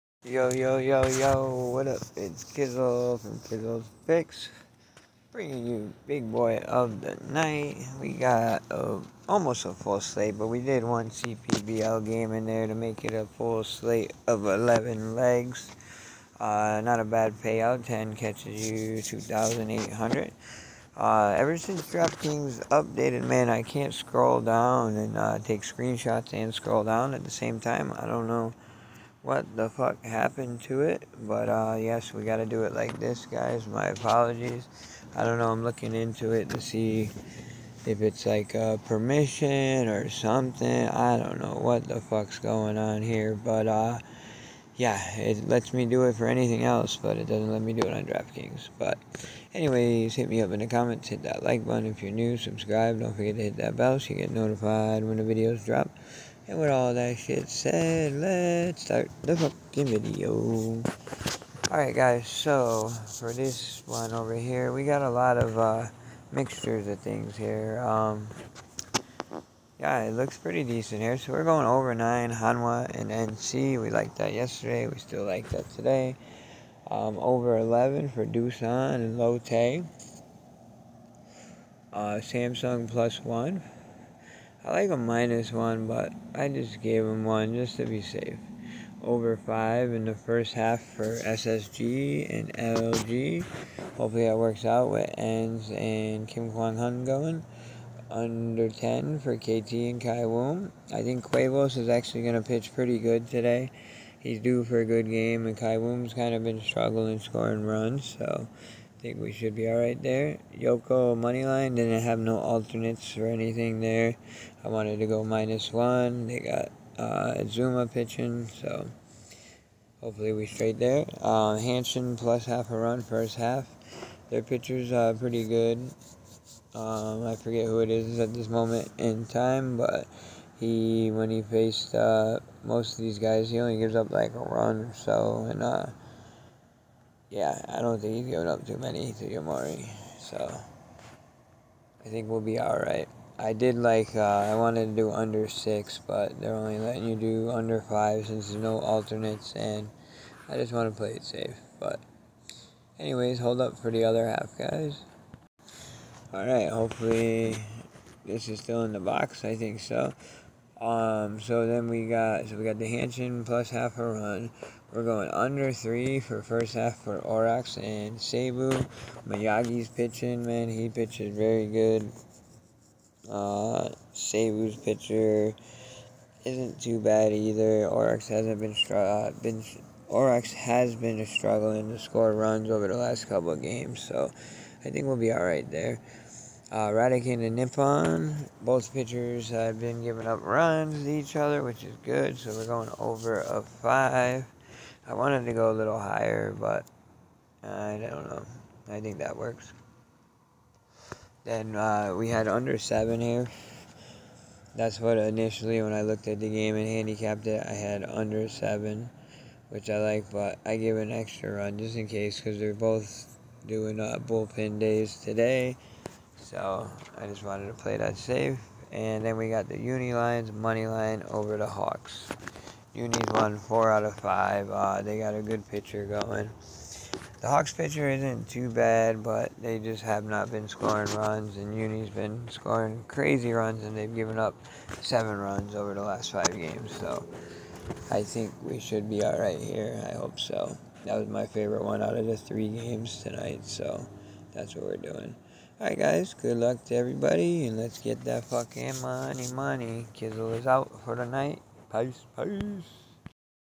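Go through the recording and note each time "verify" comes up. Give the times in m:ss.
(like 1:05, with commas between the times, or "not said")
not said.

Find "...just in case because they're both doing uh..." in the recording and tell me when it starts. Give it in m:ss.
3:31.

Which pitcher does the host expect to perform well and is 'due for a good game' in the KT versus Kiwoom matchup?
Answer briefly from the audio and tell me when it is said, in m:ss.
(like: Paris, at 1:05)
Cuevas, at 1:41.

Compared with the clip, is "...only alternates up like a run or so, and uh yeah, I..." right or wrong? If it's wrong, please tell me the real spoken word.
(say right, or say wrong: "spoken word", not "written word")
wrong: "gives", not "alternates".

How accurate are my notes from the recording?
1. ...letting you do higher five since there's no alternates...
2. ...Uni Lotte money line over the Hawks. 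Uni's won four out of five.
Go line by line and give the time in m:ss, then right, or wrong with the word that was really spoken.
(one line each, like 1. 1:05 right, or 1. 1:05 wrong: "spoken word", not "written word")
1. 2:26 wrong: "under", not "higher"
2. 3:39 wrong: "Lions", not "Lotte".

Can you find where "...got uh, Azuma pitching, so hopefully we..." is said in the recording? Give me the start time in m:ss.
1:56.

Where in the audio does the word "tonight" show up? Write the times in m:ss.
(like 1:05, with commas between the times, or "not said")
4:03.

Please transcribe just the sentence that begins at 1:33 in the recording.
Hopefully that works out with Enns and Kim Kwang Hyun going.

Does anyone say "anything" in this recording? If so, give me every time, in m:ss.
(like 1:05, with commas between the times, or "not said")
0:46, 1:53.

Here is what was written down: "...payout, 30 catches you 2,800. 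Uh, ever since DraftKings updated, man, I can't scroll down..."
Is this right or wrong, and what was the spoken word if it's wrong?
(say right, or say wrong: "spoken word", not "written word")
wrong: "10", not "30".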